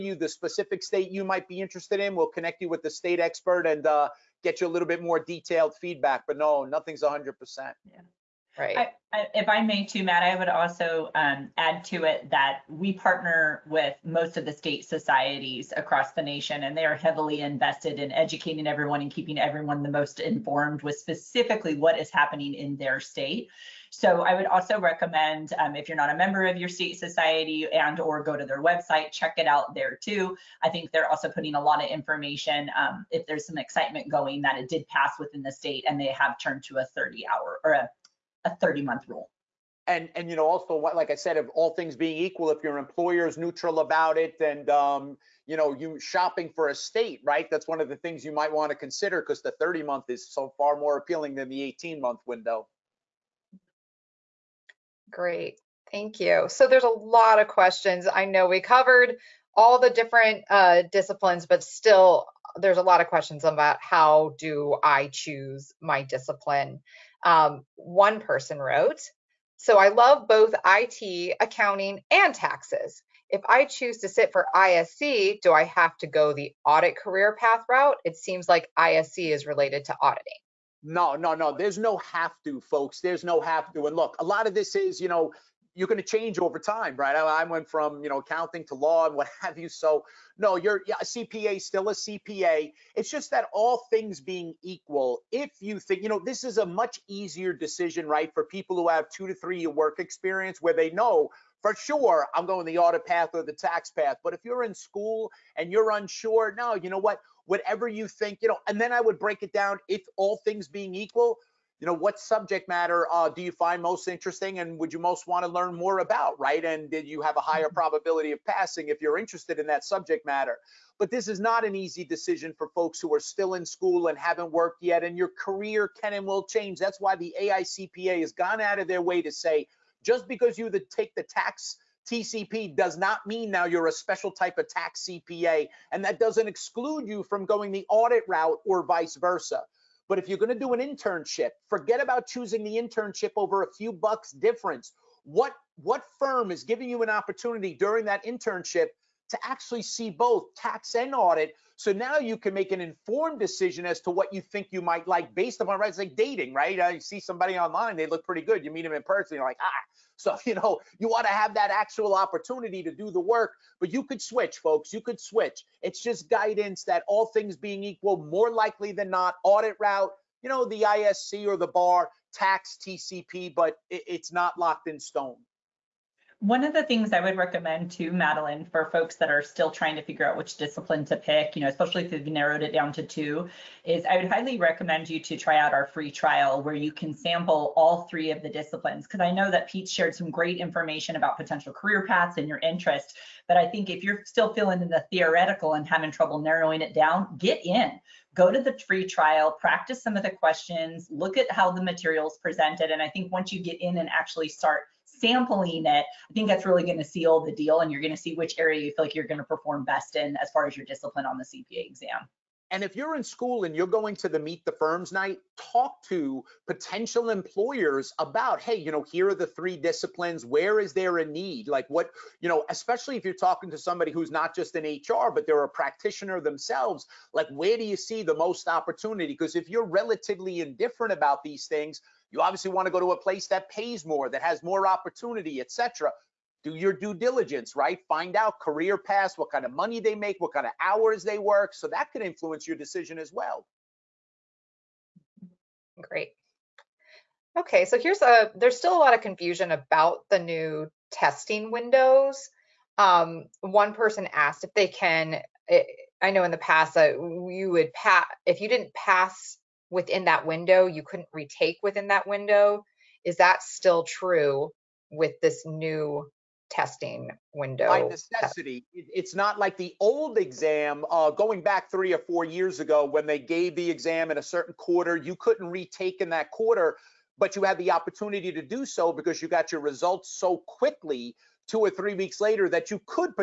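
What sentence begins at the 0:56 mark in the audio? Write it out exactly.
So there's a lot of questions.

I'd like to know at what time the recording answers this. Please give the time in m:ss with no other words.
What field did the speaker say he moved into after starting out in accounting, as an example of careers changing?
1:28.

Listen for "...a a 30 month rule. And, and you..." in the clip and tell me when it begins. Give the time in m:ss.
0:37.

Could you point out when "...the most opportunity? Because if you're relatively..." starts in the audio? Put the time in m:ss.
3:48.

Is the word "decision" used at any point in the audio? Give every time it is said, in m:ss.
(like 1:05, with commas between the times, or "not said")
1:37, 2:02, 2:33, 4:02.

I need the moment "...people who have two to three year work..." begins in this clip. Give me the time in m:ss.
1:38.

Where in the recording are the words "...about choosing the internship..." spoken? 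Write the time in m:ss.
2:22.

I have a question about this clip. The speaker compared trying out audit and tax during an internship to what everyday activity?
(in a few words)
dating.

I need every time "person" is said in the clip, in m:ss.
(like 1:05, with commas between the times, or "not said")
1:08, 2:39, 4:13.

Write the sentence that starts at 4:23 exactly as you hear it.
Is that still true with this new testing window?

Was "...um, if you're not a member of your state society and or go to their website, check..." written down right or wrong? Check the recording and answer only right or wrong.
right.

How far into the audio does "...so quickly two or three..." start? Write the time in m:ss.
4:40.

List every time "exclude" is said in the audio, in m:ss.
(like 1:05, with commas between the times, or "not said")
2:16.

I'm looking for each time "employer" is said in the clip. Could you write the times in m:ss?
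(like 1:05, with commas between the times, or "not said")
0:42, 3:37.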